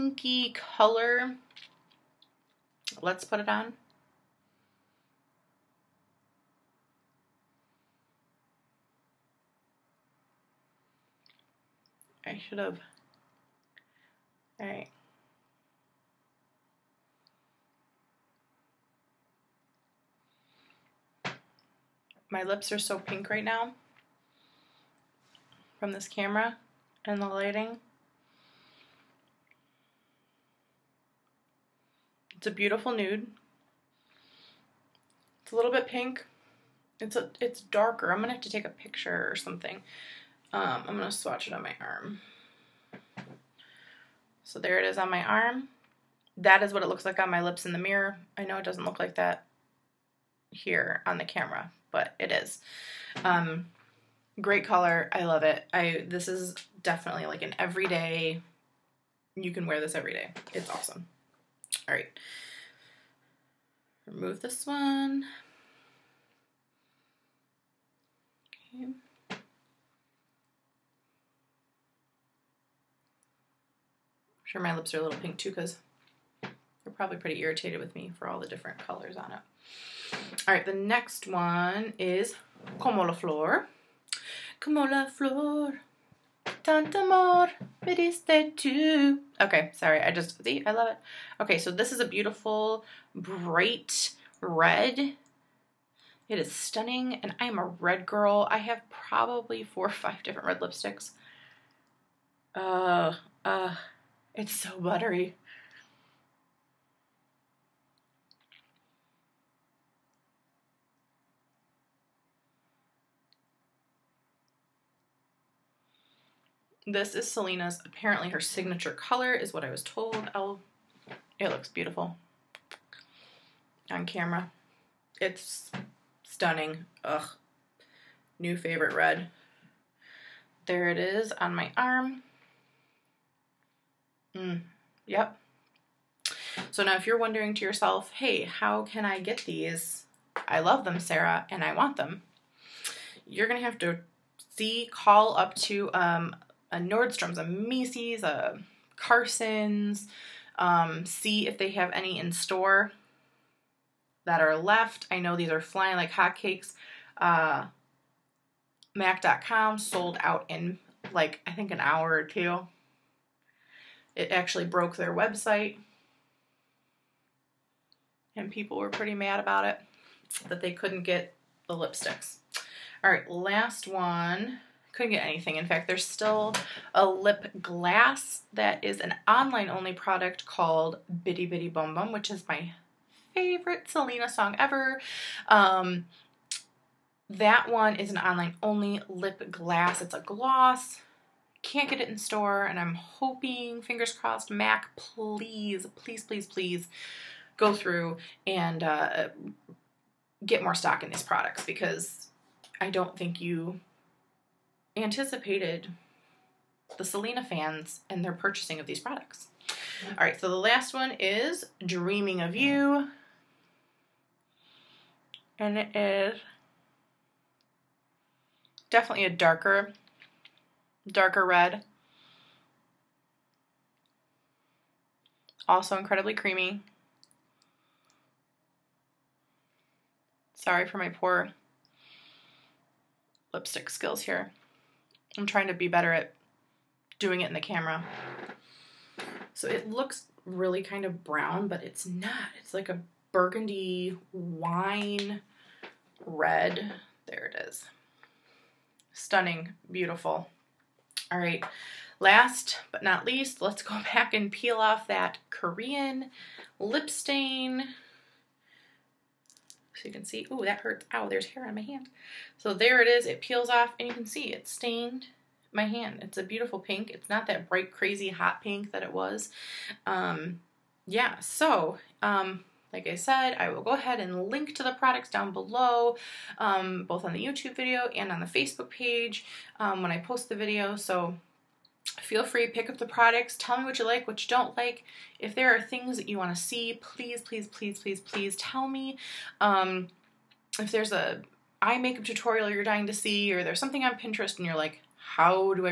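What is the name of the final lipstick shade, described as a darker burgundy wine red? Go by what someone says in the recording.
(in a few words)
Dreaming of You.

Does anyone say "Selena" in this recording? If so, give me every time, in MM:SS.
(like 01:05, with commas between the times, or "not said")
01:57, 03:03, 03:27.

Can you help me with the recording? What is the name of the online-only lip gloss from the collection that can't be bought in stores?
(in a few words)
Bidi Bidi Bom Bom.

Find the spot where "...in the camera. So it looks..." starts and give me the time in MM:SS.
03:57.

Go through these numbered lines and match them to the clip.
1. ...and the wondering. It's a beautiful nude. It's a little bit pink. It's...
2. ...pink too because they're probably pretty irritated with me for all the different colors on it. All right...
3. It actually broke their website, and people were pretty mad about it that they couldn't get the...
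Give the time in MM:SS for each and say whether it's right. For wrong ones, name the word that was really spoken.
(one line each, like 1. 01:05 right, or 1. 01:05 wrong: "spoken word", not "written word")
1. 00:27 wrong: "lighting", not "wondering"
2. 01:15 right
3. 02:44 right.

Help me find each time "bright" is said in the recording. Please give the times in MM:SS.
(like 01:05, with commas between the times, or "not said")
01:33, 04:27.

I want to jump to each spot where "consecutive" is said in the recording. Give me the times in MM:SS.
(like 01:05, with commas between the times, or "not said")
not said.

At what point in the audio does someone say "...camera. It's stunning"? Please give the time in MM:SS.
02:04.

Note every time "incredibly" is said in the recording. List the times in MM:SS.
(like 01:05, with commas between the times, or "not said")
03:45.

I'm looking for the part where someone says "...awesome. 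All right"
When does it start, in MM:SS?
01:00.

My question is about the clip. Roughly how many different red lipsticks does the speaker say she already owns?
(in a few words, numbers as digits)
4 or 5.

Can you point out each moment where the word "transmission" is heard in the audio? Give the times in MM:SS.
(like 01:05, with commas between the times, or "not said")
not said.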